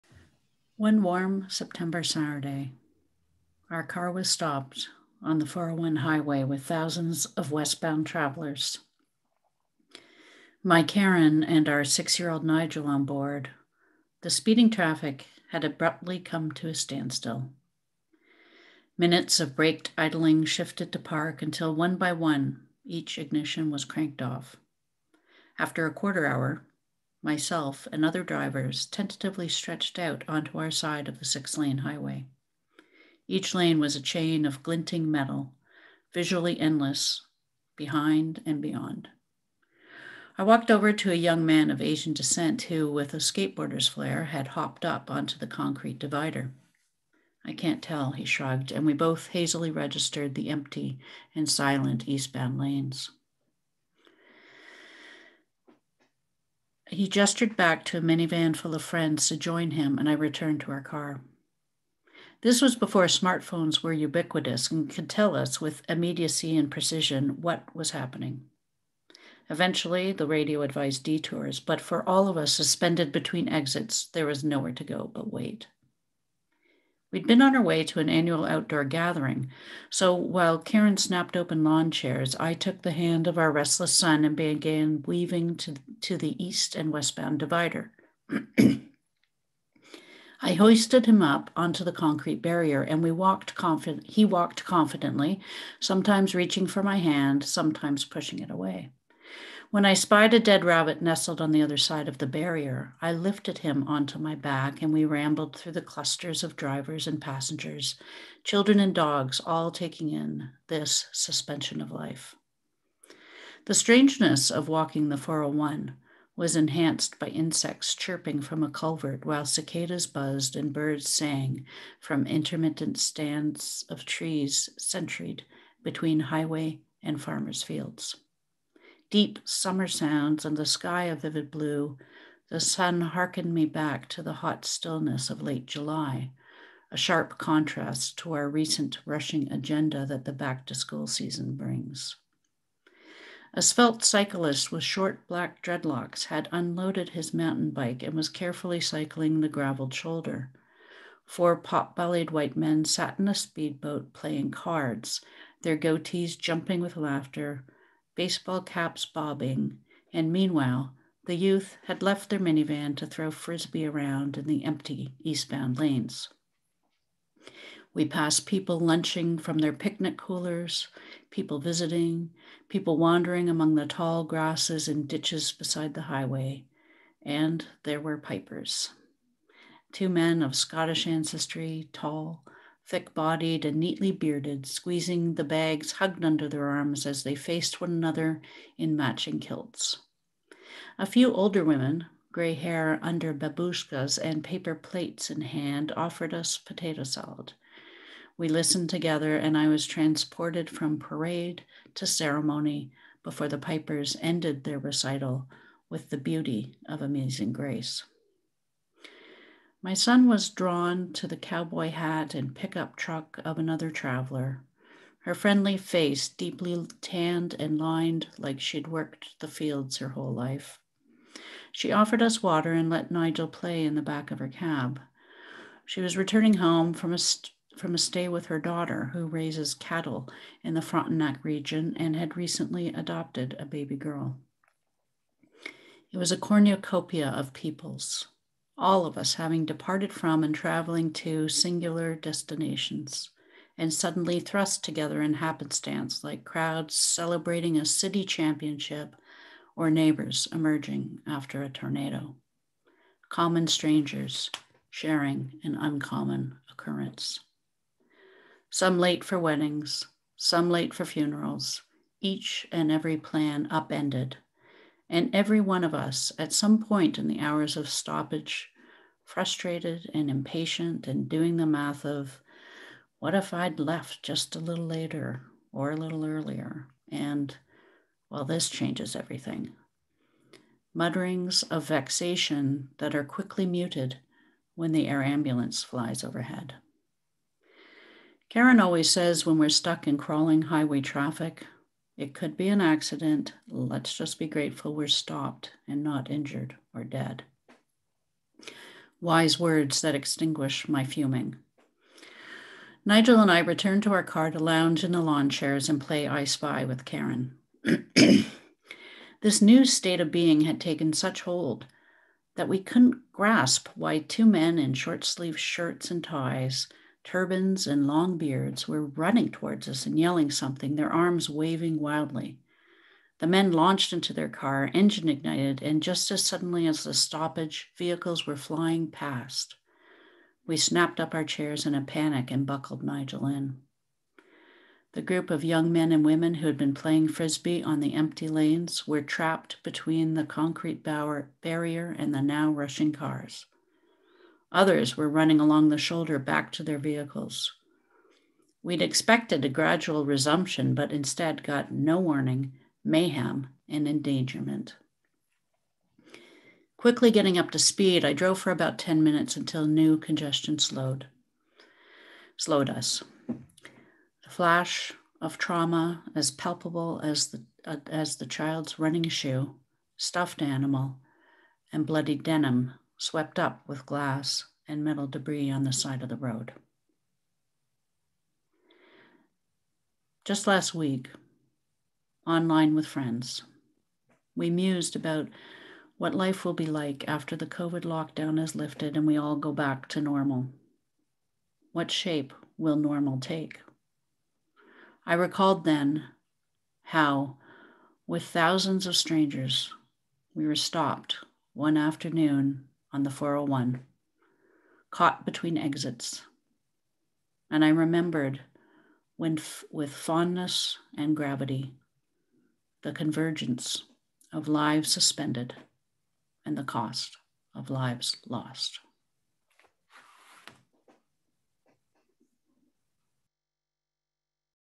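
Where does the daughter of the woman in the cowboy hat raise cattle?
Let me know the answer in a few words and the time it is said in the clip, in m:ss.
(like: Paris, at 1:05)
Frontenac region, at 3:50.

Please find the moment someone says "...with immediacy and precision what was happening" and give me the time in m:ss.
1:05.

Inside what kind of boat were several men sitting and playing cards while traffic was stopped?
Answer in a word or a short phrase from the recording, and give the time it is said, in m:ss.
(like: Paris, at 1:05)
Speedboat, at 2:33.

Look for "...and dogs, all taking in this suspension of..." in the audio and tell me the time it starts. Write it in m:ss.
1:48.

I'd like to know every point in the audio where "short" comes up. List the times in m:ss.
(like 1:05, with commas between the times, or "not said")
2:24, 5:14.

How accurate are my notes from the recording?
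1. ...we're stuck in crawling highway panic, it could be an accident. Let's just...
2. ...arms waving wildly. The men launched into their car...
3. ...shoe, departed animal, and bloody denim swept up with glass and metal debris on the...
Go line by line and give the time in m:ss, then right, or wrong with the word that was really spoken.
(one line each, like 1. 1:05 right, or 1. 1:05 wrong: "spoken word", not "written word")
1. 4:49 wrong: "traffic", not "panic"
2. 5:21 right
3. 6:09 wrong: "stuffed", not "departed".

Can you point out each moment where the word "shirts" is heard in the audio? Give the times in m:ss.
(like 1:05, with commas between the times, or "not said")
5:15.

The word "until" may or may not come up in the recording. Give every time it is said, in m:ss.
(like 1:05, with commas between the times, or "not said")
0:21, 5:59.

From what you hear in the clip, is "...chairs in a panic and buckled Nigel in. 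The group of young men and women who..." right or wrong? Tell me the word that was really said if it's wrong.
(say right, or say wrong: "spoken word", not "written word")
right.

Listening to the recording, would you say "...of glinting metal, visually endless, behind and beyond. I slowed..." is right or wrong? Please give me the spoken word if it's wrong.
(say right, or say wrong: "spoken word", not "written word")
wrong: "walked", not "slowed".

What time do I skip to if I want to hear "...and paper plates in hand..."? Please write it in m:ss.
3:14.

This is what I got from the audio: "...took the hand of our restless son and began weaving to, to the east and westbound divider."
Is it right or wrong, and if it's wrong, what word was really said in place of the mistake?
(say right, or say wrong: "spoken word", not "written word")
right.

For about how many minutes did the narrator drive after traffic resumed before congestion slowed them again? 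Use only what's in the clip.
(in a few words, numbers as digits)
10.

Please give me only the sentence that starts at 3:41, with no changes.
She offered us water and let Nigel play in the back of her cab.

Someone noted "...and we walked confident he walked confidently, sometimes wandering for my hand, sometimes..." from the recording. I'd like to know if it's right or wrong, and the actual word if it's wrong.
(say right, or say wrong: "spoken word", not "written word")
wrong: "reaching", not "wandering".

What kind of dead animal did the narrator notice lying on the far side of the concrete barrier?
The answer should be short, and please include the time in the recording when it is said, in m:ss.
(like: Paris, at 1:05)
Rabbit, at 1:40.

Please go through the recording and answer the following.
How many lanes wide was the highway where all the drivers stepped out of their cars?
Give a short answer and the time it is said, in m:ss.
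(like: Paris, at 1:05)
6, at 0:31.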